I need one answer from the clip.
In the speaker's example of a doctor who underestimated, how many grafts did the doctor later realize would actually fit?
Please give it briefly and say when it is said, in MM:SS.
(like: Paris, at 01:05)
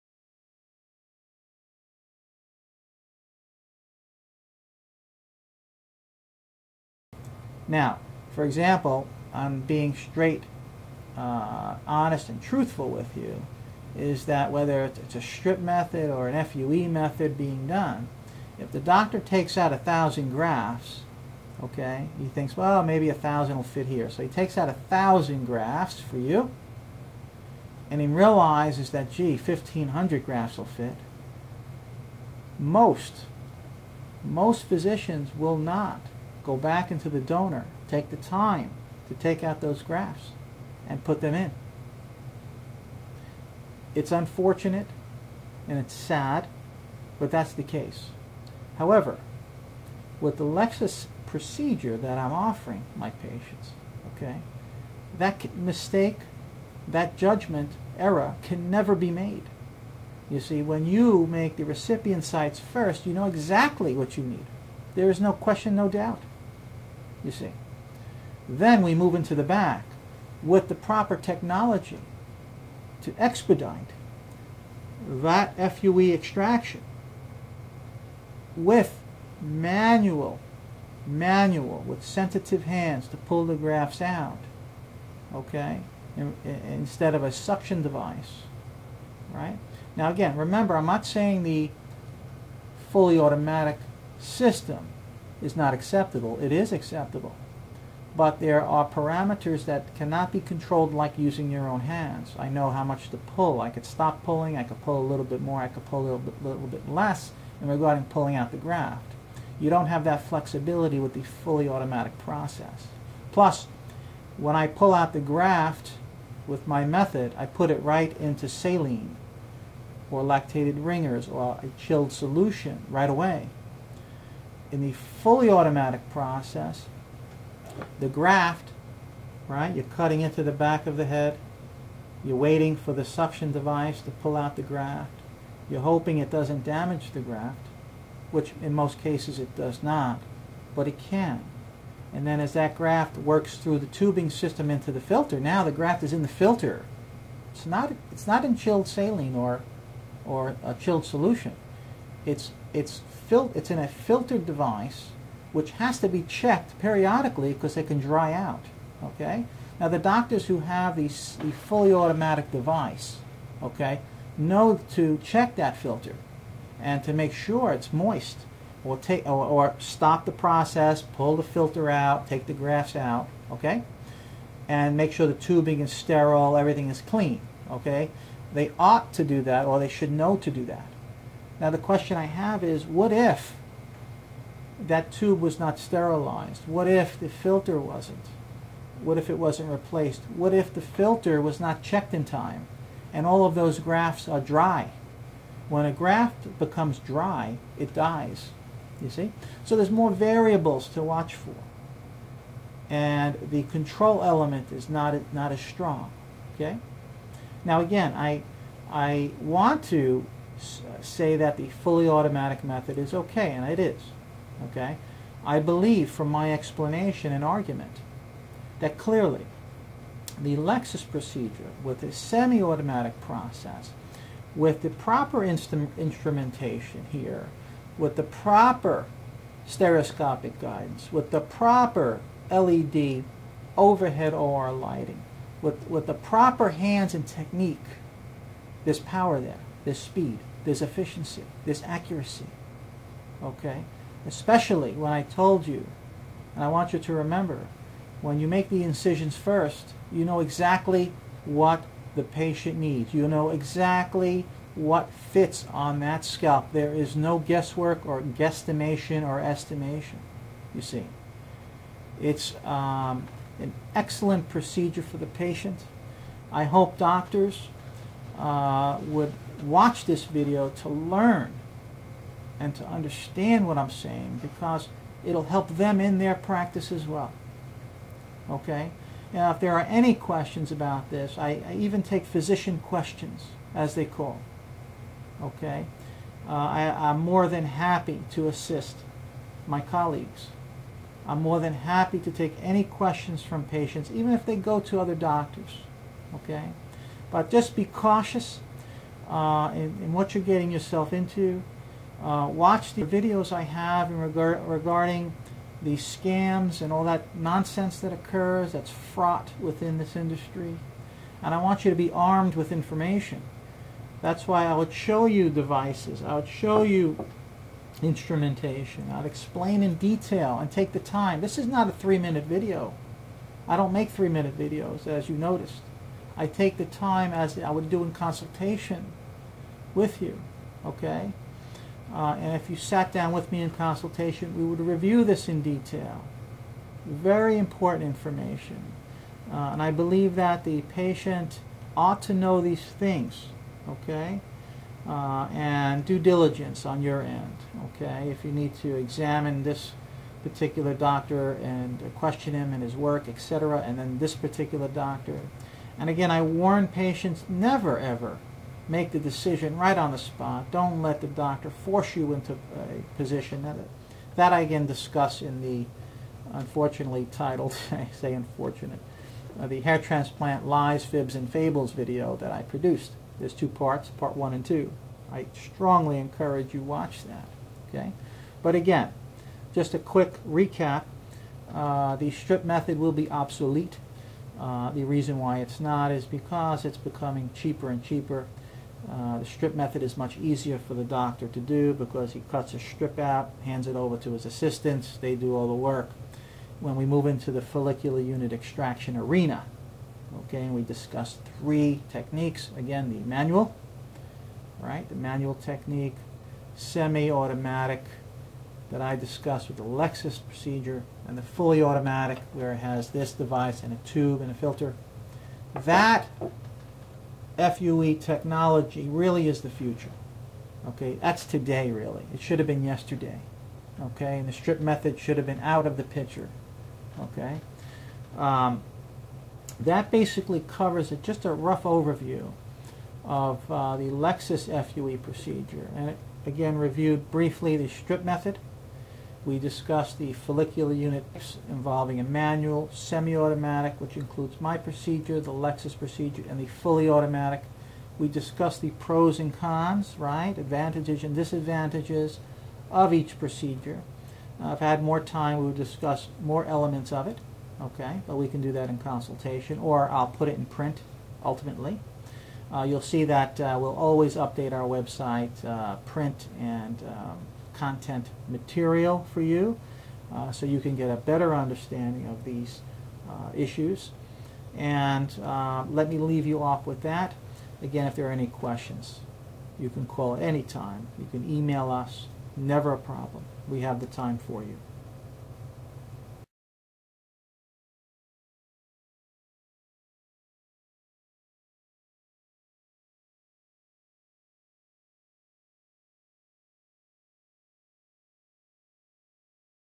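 1,500, at 00:29.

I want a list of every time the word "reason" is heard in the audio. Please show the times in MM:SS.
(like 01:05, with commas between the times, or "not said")
06:25.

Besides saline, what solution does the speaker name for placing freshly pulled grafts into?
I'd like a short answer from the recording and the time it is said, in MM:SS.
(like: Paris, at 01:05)
lactated ringers, at 02:00.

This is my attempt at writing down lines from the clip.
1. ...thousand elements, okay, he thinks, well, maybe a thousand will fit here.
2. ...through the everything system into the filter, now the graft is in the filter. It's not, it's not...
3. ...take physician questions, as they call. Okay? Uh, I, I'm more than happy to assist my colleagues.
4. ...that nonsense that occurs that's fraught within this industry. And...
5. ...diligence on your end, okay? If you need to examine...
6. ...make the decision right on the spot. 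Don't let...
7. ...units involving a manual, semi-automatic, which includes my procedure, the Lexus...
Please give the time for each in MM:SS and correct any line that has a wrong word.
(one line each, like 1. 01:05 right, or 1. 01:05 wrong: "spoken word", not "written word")
1. 00:19 wrong: "grafts", not "elements"
2. 02:23 wrong: "tubing", not "everything"
3. 04:42 right
4. 05:07 right
5. 05:46 right
6. 05:58 right
7. 07:20 right.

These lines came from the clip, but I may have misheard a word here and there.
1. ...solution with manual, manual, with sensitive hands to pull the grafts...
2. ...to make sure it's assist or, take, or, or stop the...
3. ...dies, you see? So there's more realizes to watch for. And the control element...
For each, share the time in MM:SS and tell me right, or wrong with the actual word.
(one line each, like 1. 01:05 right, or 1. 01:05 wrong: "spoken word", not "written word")
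1. 01:16 wrong: "extraction", not "solution"
2. 02:47 wrong: "moist", not "assist"
3. 03:17 wrong: "variables", not "realizes".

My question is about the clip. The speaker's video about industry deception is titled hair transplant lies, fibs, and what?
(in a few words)
fables.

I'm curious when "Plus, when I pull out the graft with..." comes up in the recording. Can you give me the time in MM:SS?
01:53.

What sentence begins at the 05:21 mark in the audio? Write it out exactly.
This is not a three-minute video.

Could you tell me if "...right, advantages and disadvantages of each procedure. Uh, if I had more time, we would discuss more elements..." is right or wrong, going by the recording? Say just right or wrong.
right.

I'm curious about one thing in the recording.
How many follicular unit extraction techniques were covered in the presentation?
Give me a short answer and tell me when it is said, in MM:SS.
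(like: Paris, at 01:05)
3, at 06:41.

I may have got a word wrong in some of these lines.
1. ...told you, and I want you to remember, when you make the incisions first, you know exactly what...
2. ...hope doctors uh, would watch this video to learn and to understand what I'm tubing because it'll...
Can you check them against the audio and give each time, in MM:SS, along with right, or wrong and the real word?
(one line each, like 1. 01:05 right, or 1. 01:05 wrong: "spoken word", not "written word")
1. 04:05 right
2. 04:26 wrong: "saying", not "tubing".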